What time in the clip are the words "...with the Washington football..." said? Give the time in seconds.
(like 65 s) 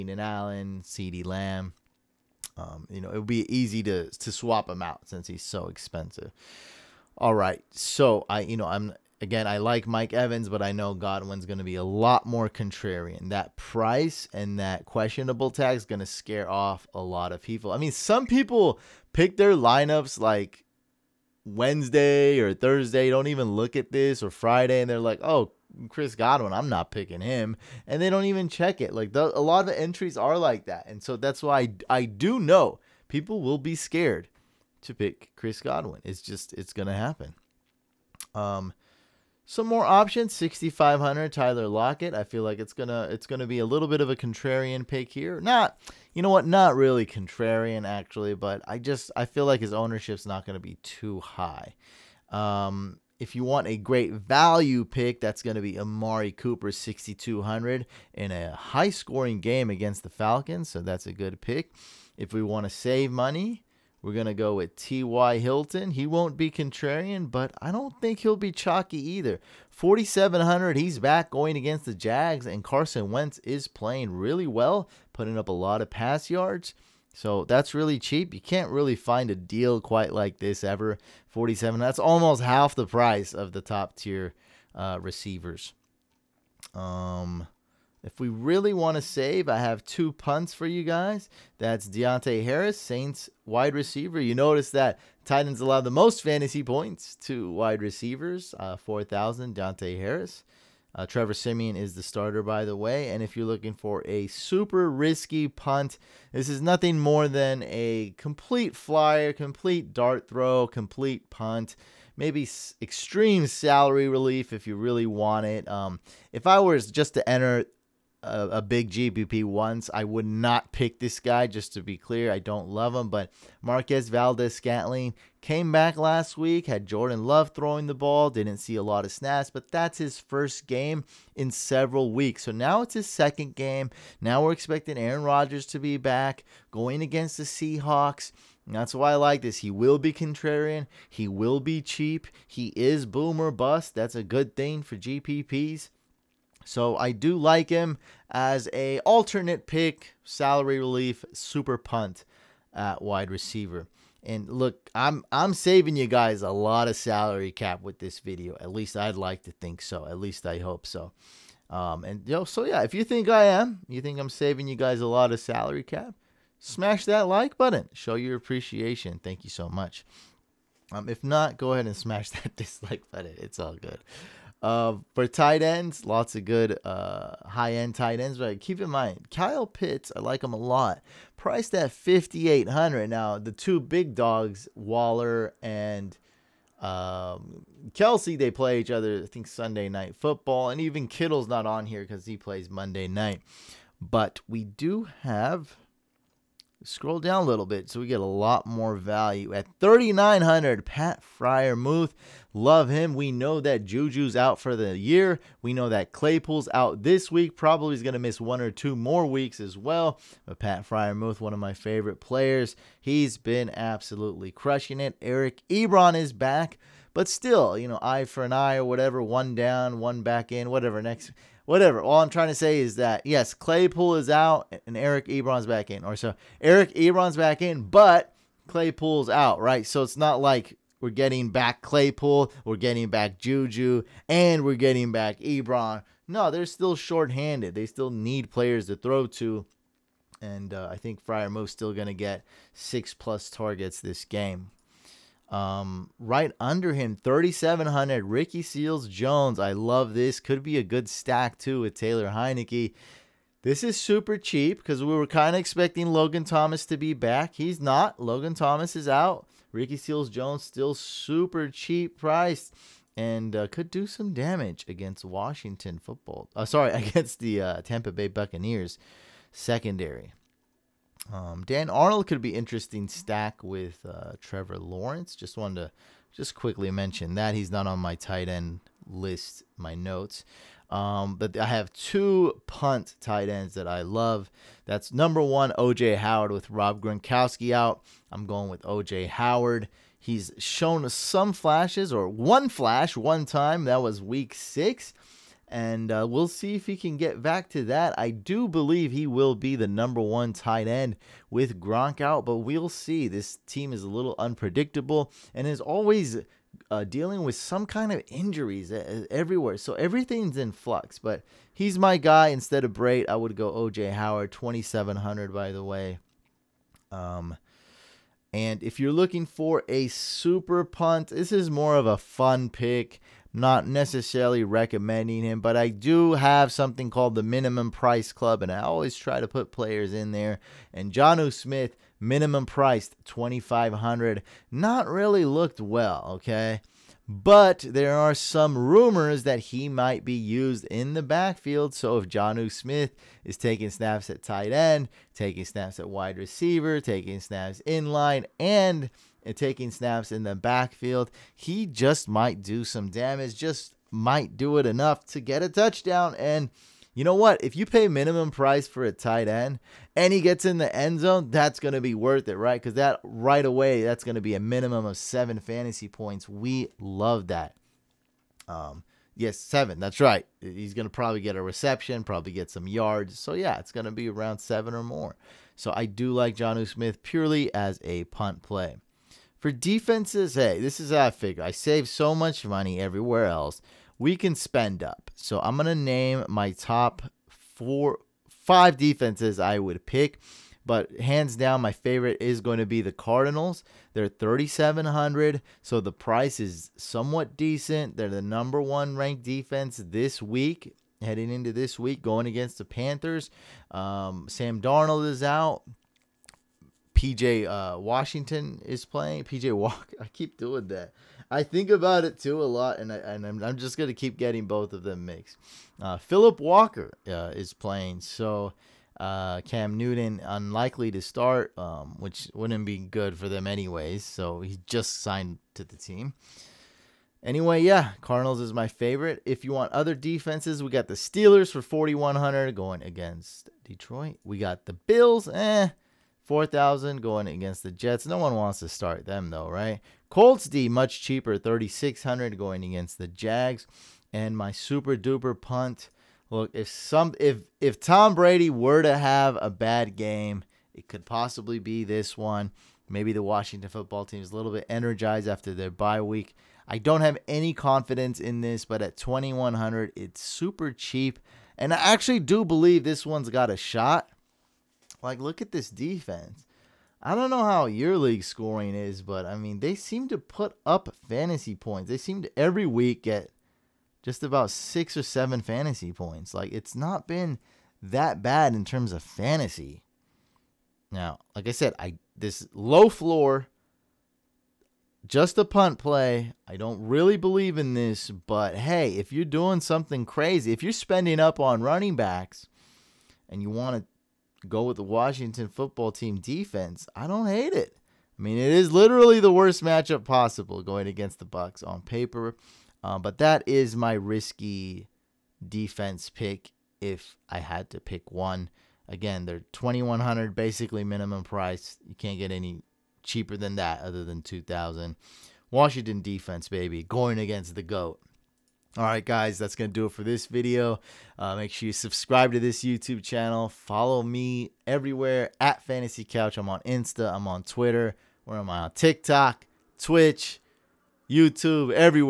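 494 s.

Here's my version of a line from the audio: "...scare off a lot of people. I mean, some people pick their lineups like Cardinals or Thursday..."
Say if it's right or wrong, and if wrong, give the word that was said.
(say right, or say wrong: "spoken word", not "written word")
wrong: "Wednesday", not "Cardinals".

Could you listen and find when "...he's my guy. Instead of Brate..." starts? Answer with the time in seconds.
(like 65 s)
311 s.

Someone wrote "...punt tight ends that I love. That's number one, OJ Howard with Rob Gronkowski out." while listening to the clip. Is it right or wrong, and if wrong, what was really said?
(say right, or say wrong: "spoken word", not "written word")
right.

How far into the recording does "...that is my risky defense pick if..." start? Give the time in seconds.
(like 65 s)
503 s.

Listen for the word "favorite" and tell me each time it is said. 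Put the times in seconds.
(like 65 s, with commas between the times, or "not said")
211 s, 391 s, 428 s.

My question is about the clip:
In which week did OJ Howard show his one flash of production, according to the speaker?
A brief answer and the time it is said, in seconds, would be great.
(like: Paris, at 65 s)
week 6, at 294 s.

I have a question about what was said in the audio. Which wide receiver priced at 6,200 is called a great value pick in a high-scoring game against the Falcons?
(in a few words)
Amari Cooper.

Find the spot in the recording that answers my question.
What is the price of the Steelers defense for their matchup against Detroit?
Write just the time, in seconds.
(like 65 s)
431 s.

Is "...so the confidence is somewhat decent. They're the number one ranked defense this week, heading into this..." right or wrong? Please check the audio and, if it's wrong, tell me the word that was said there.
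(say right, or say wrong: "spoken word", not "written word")
wrong: "price", not "confidence".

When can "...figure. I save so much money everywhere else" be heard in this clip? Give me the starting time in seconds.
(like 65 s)
381 s.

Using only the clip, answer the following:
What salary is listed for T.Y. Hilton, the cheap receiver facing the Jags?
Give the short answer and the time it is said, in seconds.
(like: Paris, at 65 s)
4,700, at 69 s.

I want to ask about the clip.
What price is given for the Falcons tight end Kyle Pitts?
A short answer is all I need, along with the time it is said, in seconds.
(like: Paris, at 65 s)
5,800, at 181 s.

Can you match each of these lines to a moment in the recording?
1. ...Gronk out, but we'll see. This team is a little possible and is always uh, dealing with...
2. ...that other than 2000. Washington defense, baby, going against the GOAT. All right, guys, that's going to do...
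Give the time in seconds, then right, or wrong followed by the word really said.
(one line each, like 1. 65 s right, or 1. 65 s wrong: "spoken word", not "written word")
1. 301 s wrong: "unpredictable", not "possible"
2. 513 s right.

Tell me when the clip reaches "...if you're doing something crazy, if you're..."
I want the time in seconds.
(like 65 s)
489 s.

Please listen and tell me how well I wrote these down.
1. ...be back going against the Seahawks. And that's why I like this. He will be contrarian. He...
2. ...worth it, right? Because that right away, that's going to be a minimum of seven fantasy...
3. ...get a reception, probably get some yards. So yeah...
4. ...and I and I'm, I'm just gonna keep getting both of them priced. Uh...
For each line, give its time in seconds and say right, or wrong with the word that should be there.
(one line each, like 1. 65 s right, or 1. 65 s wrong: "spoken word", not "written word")
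1. 135 s right
2. 362 s right
3. 371 s right
4. 412 s wrong: "mixed", not "priced".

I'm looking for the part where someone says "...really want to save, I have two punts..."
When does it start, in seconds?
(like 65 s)
88 s.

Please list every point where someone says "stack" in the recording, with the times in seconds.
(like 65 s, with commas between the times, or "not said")
251 s, 273 s.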